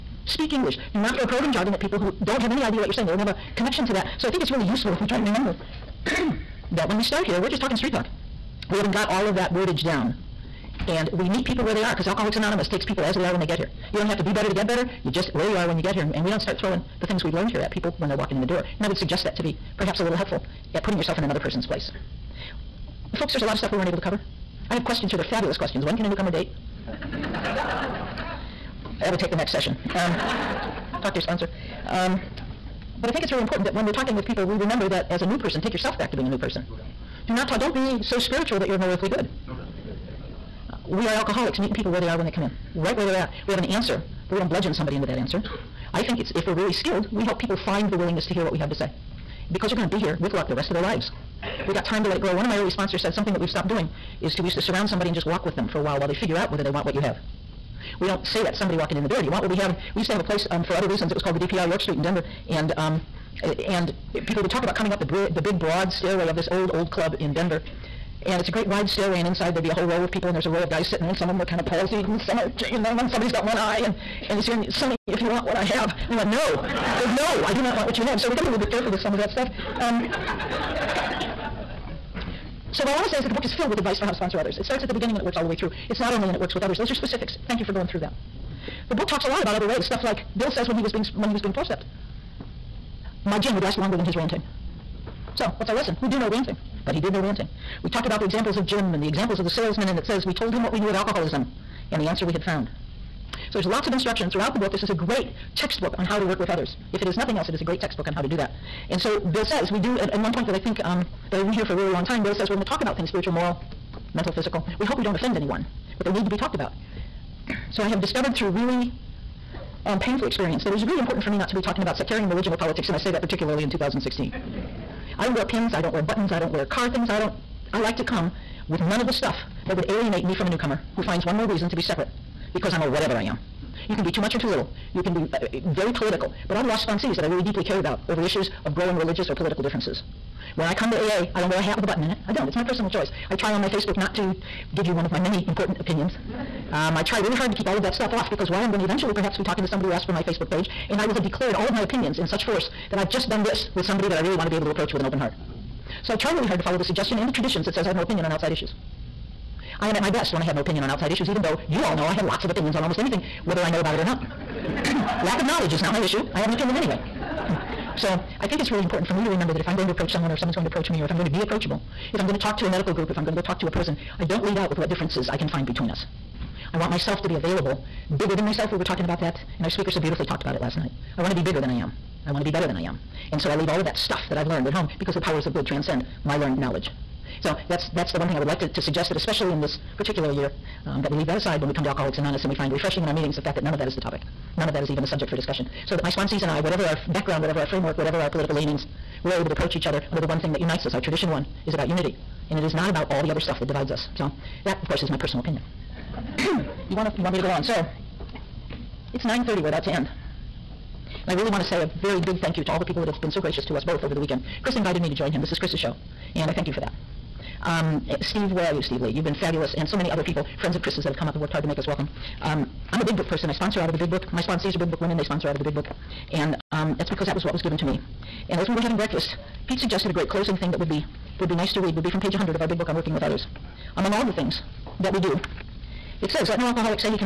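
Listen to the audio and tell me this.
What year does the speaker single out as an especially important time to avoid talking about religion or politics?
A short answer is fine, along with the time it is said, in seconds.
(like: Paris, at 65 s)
2016, at 123 s.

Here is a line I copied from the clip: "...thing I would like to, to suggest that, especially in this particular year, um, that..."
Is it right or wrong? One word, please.
right.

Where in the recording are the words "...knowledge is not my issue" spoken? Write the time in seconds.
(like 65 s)
165 s.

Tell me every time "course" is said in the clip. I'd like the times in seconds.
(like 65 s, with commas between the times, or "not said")
204 s.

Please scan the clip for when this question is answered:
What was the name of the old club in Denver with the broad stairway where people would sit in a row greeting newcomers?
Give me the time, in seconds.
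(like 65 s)
61 s.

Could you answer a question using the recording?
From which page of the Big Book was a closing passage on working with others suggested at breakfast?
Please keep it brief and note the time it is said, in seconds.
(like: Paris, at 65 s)
100, at 232 s.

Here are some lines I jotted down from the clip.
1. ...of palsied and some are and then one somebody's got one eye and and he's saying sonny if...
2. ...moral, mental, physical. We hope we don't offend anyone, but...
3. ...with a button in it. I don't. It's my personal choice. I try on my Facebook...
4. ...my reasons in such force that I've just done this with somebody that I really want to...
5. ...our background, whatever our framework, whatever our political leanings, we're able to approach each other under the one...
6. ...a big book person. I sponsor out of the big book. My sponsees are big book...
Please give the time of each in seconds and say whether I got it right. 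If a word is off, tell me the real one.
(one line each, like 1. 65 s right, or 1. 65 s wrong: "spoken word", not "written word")
1. 71 s right
2. 113 s right
3. 141 s right
4. 151 s wrong: "opinions", not "reasons"
5. 196 s right
6. 223 s right.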